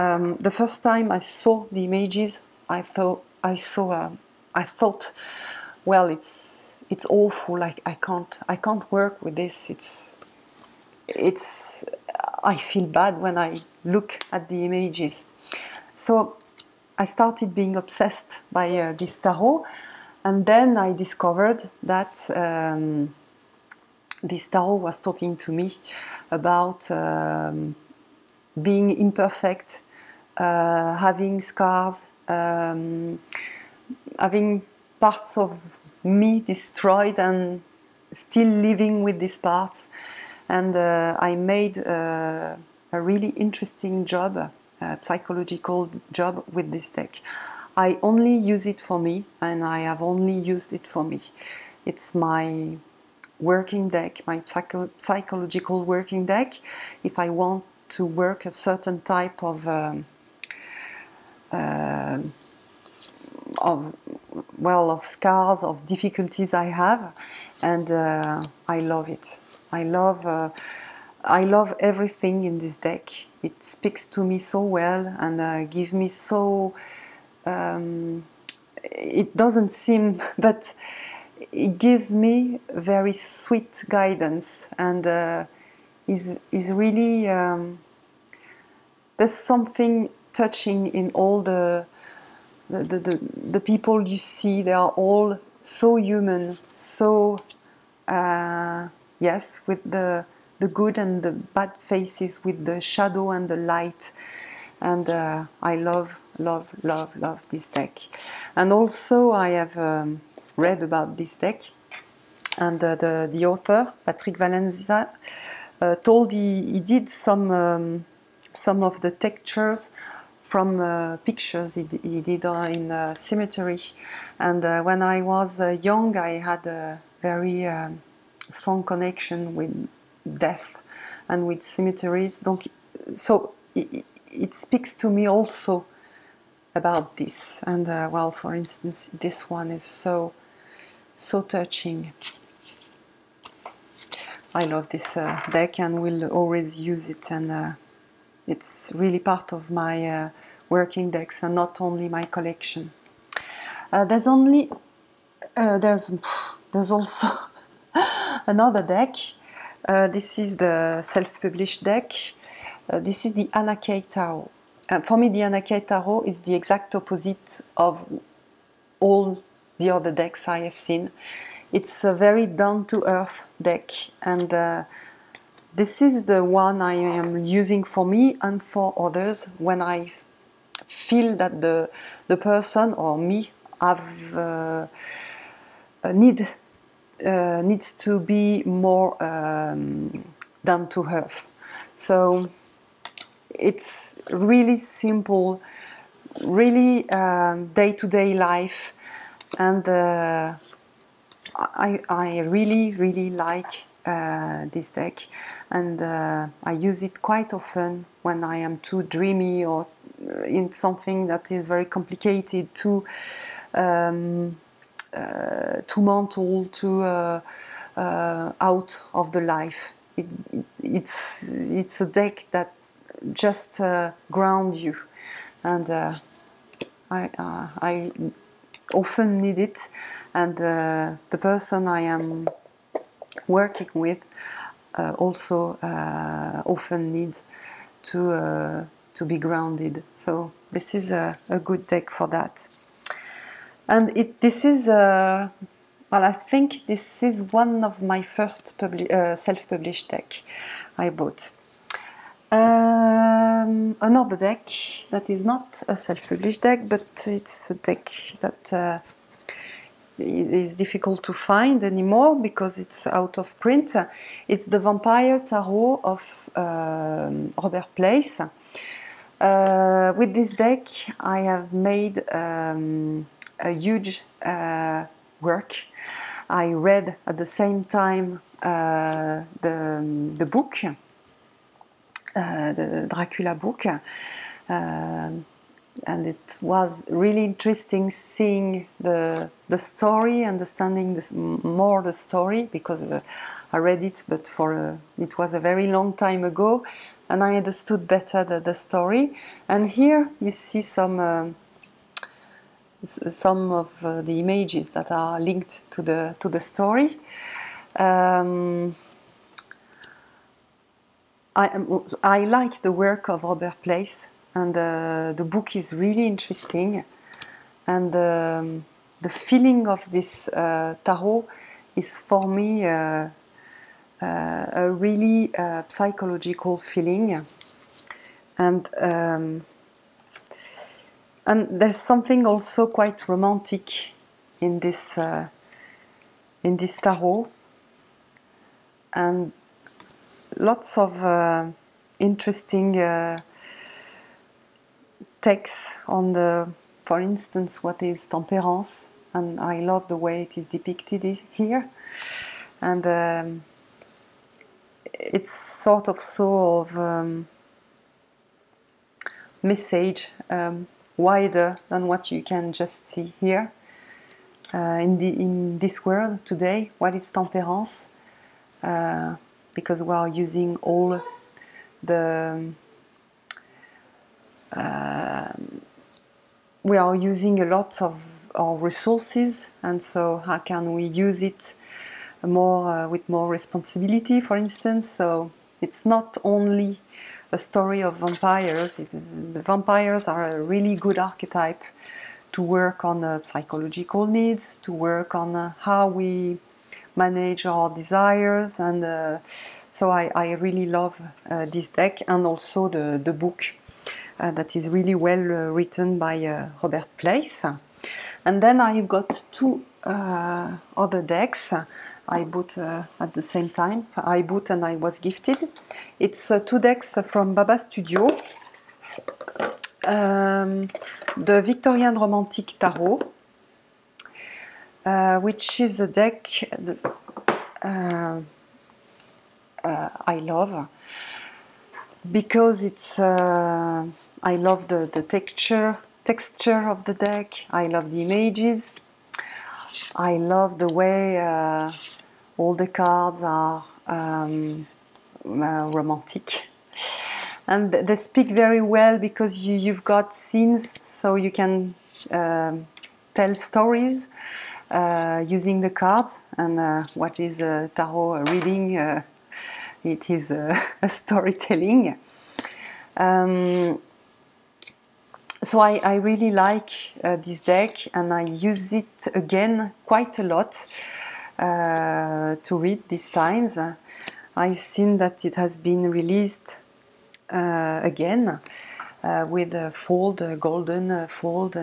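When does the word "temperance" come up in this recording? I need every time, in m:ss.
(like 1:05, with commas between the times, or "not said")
5:48, 6:07.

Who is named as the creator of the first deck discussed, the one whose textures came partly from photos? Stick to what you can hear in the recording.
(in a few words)
Patrick Valenza.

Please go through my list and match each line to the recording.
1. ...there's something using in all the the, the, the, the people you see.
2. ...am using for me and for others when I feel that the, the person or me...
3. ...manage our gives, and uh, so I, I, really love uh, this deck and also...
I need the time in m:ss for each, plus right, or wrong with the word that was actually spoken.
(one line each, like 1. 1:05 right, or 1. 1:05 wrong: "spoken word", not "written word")
1. 1:29 wrong: "touching", not "using"
2. 2:56 right
3. 6:37 wrong: "desires", not "gives".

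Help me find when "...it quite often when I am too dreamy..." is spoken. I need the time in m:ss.
3:27.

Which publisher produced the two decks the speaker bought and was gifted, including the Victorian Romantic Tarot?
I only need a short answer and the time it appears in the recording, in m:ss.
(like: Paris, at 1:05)
Baba Studio, at 6:57.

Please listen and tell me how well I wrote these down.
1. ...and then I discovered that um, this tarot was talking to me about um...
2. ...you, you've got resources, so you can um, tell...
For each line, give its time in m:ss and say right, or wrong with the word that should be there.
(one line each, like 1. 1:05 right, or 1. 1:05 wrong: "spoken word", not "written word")
1. 0:20 right
2. 7:29 wrong: "scenes", not "resources".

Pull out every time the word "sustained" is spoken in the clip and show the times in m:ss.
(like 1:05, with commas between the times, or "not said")
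not said.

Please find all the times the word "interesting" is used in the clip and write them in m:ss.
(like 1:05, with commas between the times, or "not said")
0:43, 4:47, 5:16, 5:42.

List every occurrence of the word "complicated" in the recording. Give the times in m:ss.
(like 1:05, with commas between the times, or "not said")
3:31.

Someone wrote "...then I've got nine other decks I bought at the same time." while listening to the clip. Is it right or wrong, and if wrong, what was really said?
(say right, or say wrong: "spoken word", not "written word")
wrong: "two", not "nine".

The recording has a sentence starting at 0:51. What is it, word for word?
It's my working deck, my psycho psychological working deck.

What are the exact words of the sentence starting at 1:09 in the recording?
I love uh, I love everything in this deck.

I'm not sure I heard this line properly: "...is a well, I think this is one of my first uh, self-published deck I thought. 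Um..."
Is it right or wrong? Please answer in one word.
wrong.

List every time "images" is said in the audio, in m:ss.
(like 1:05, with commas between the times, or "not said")
0:01, 0:14, 5:04, 7:18.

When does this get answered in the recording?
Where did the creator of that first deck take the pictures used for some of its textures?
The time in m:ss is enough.
2:03.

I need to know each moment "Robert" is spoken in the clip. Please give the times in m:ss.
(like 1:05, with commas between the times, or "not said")
4:27, 5:13, 6:46.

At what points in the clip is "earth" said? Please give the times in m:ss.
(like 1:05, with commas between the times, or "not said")
2:53, 3:11.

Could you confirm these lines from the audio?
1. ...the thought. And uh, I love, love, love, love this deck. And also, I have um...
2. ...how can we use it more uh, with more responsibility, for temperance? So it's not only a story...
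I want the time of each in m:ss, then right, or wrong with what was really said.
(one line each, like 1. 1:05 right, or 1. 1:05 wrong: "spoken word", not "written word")
1. 1:43 wrong: "light", not "thought"
2. 6:20 wrong: "instance", not "temperance".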